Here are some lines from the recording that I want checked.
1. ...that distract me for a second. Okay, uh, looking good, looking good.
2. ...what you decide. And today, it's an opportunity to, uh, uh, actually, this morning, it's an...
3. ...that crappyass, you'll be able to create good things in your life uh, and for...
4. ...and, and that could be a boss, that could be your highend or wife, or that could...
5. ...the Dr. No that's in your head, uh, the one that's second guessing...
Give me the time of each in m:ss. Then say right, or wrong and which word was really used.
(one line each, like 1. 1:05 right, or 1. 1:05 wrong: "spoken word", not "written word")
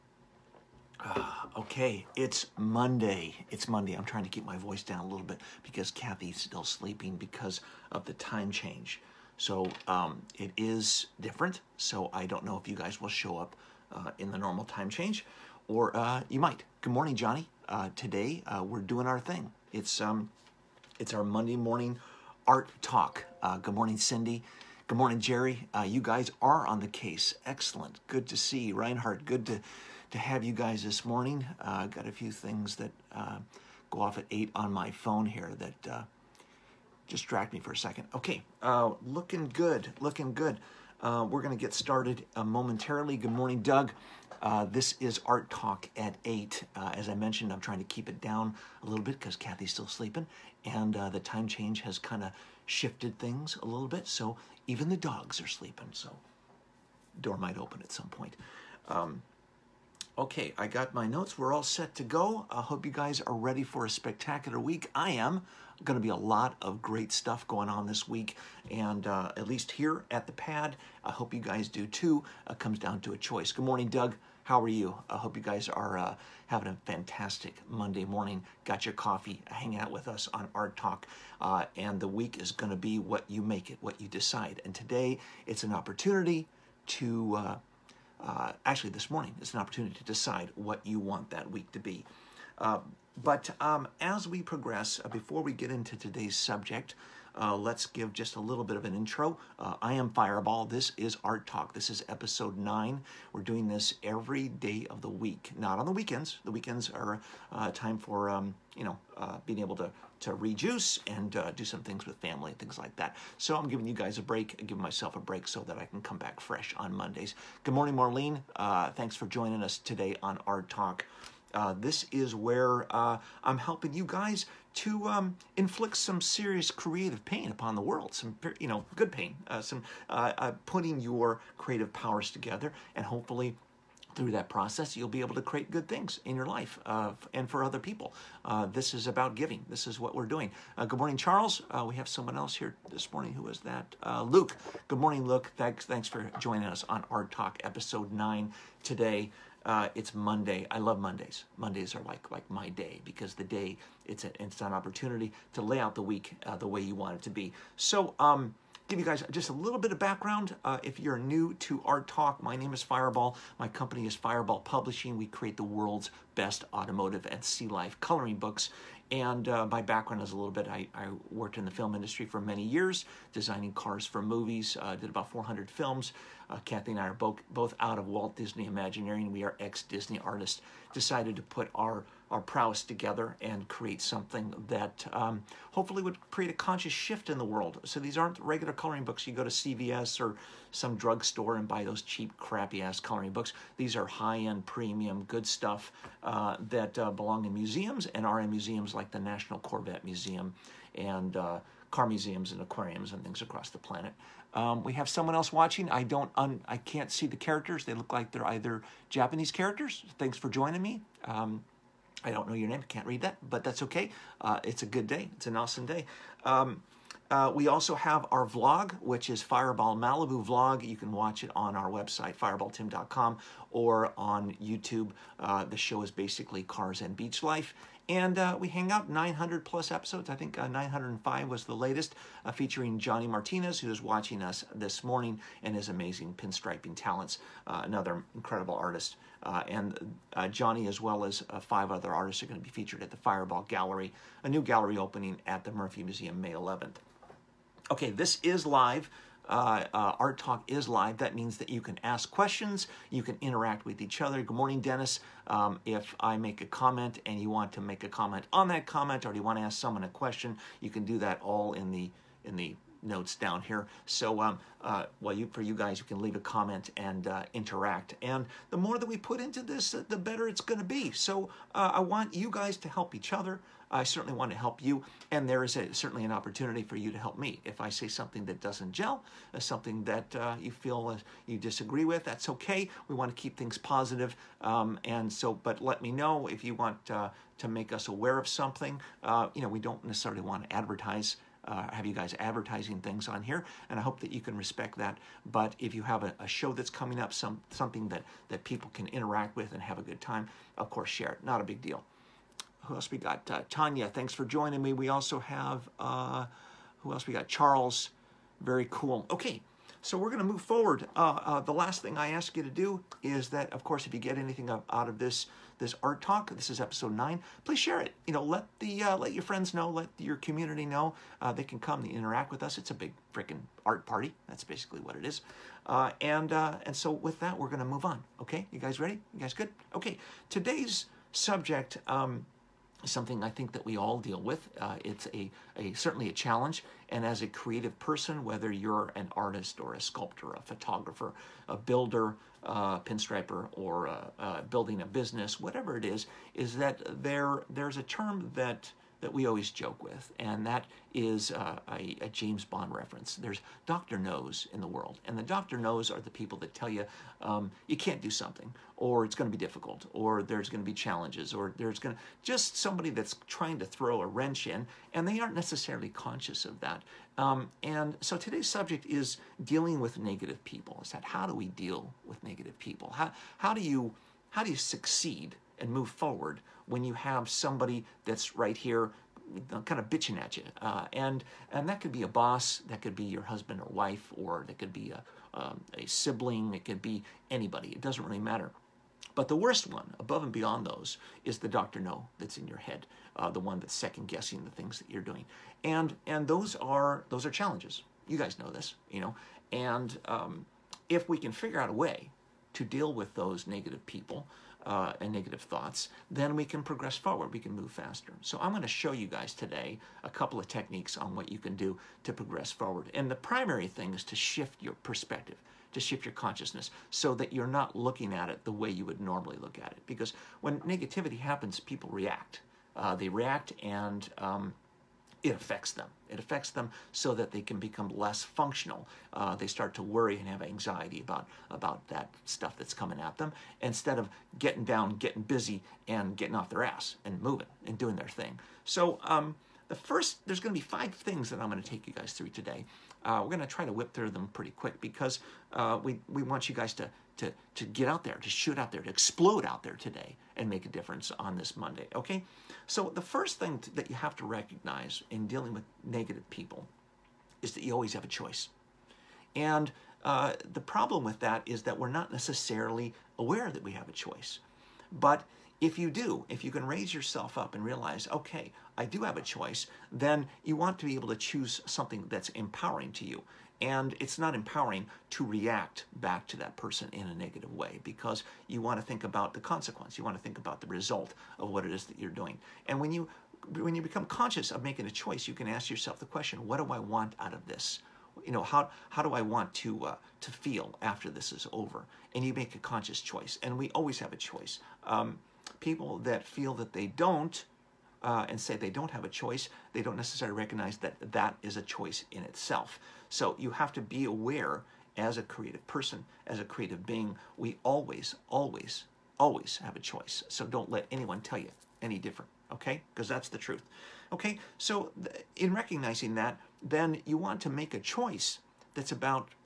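1. 0:35 right
2. 1:23 right
3. 2:14 wrong: "process", not "crappyass"
4. 6:21 wrong: "husband", not "highend"
5. 6:31 right.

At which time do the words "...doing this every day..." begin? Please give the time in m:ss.
1:43.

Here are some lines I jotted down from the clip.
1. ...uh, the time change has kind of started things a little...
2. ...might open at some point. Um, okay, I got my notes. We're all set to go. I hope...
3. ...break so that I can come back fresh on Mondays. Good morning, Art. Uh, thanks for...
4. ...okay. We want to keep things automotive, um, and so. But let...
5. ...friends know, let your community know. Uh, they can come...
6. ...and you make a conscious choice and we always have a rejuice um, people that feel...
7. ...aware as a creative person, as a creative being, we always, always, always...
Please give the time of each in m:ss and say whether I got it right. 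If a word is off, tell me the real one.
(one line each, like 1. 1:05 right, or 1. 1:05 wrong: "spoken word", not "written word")
1. 0:50 wrong: "shifted", not "started"
2. 0:57 right
3. 1:55 wrong: "Marlene", not "Art"
4. 4:42 wrong: "positive", not "automotive"
5. 5:19 right
6. 8:12 wrong: "choice", not "rejuice"
7. 8:24 right.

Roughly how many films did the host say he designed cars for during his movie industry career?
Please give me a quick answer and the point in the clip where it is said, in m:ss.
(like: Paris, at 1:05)
400, at 2:55.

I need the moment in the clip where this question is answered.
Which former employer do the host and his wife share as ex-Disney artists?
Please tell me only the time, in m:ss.
2:58.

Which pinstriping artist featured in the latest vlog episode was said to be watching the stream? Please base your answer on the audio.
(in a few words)
Johnny Martinez.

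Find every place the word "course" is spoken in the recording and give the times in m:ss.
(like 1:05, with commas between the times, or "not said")
5:00, 5:13.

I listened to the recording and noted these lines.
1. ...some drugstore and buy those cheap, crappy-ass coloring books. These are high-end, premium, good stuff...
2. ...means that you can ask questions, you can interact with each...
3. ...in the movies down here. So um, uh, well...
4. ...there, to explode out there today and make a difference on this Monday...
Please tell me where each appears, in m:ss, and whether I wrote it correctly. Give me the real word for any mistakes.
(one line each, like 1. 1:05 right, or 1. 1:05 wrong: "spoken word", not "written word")
1. 3:10 right
2. 4:11 right
3. 4:22 wrong: "notes", not "movies"
4. 7:28 right.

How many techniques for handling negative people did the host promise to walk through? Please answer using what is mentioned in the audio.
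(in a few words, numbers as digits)
5.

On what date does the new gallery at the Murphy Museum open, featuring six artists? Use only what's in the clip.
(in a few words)
May 11.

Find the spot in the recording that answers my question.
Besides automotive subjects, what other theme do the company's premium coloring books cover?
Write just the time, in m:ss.
2:47.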